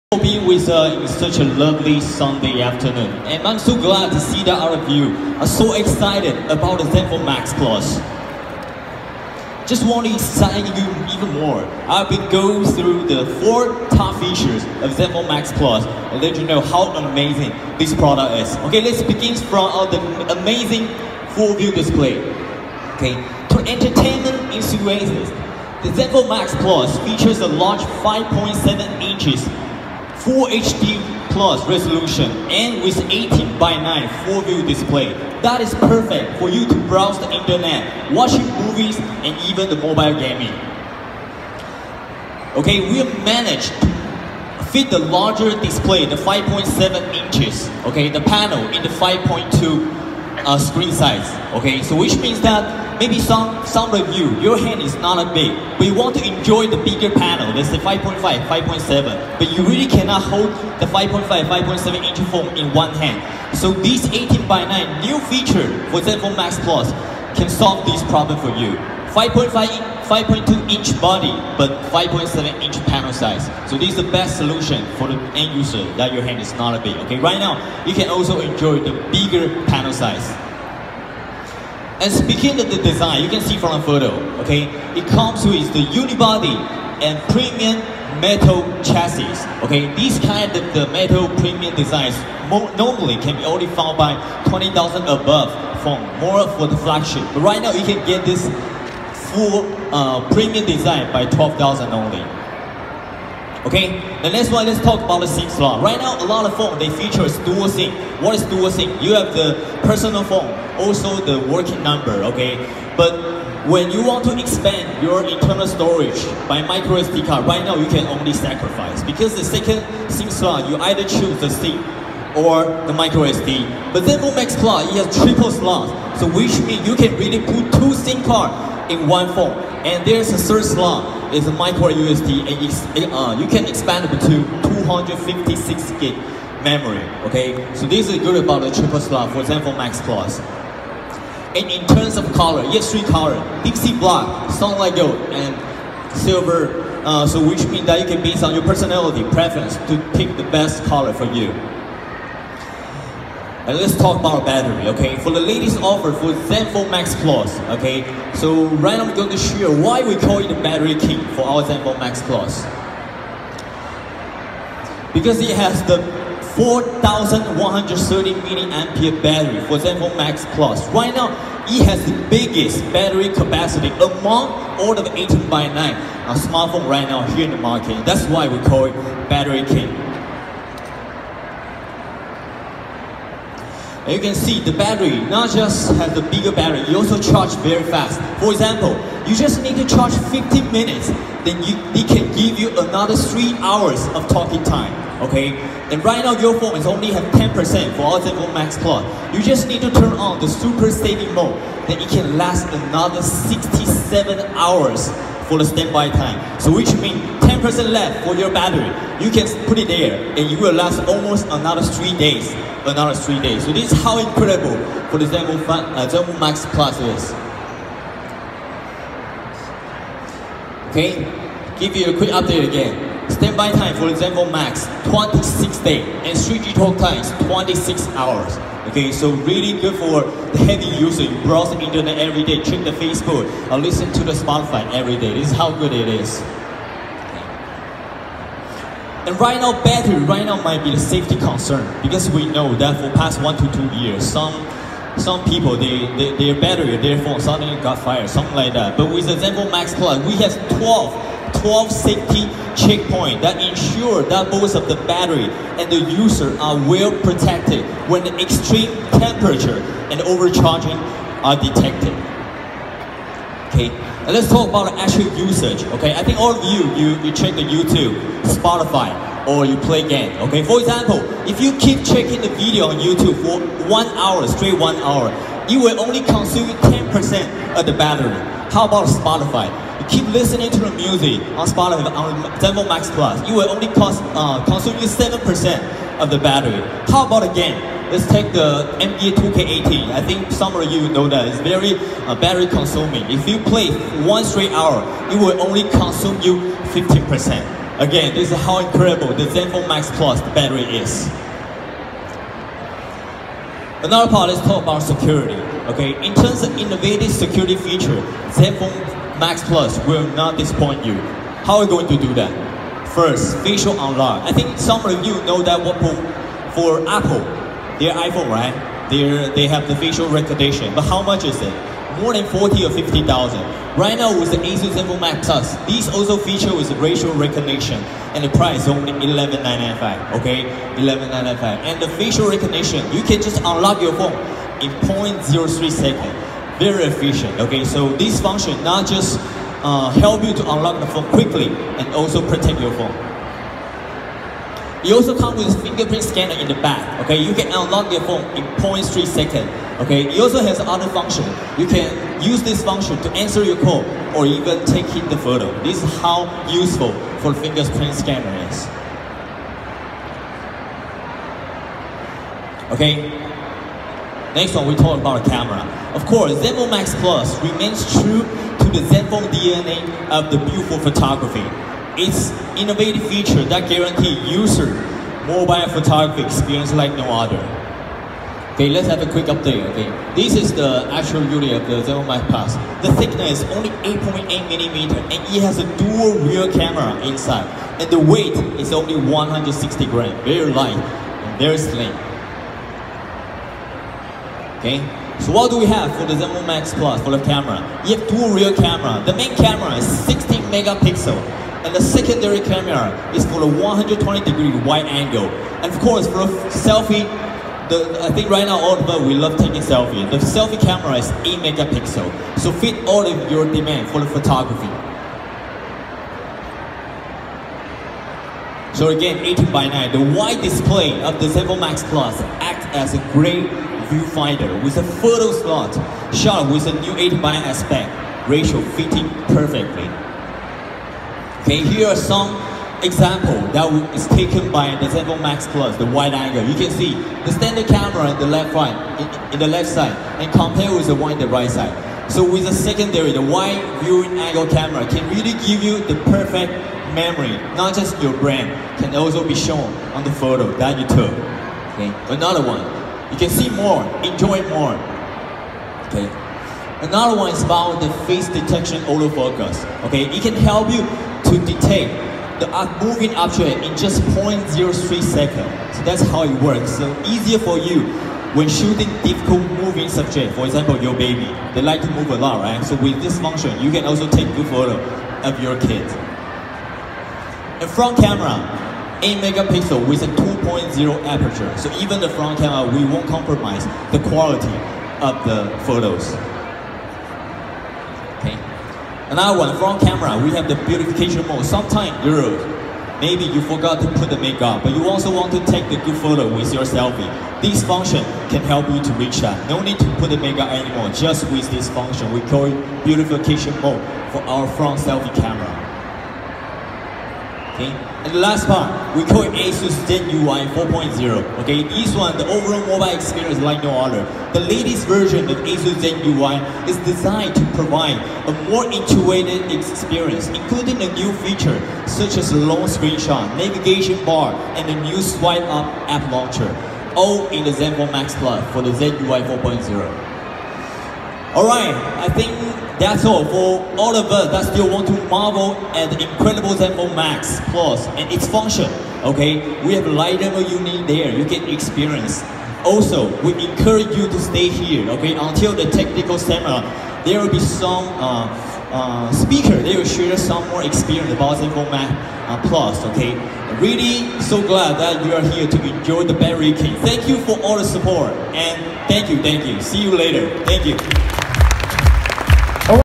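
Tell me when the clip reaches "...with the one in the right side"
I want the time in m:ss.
7:20.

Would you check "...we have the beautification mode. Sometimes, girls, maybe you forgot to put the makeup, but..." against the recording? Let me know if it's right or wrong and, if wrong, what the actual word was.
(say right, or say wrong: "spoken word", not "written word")
right.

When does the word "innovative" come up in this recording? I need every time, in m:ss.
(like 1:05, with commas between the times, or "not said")
5:06, 6:12.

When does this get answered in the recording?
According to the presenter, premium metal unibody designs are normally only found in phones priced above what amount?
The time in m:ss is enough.
1:34.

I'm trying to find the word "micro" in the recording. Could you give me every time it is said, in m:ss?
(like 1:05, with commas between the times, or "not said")
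1:56, 2:02, 2:11.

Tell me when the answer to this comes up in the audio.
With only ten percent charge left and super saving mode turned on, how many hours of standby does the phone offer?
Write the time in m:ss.
3:23.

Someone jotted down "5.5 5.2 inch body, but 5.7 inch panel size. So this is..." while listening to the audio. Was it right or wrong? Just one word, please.
right.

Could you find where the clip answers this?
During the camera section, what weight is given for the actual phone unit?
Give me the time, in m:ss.
6:29.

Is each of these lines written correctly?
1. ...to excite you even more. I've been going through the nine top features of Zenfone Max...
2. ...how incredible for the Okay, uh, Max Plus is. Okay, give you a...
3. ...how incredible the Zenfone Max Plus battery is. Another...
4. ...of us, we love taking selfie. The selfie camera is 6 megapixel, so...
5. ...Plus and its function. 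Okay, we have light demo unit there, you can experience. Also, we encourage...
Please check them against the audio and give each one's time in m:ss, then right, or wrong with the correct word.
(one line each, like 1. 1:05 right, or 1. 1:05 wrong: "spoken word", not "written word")
1. 0:10 wrong: "four", not "nine"
2. 3:34 wrong: "Zenmo", not "Okay"
3. 4:58 right
4. 6:48 wrong: "8", not "6"
5. 8:57 right.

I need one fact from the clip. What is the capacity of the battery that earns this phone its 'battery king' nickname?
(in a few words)
4130 milliampere.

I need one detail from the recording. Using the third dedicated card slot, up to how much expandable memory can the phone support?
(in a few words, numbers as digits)
256 gig.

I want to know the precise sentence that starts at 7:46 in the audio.
So easier for you when shooting difficult moving subject, for example, your baby.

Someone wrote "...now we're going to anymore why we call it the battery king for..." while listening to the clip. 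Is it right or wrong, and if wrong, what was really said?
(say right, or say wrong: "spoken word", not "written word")
wrong: "share", not "anymore".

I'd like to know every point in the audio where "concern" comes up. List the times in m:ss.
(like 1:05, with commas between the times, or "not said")
4:01.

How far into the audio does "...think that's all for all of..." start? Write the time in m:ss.
8:52.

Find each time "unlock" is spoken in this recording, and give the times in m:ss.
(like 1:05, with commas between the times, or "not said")
5:13, 5:33, 5:40, 5:47.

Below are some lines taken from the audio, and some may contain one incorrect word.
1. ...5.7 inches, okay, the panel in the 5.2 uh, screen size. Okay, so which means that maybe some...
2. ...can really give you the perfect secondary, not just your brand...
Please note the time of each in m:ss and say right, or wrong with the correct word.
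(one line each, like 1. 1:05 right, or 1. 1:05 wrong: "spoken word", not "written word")
1. 0:46 right
2. 7:25 wrong: "memory", not "secondary".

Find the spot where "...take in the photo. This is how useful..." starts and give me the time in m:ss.
5:54.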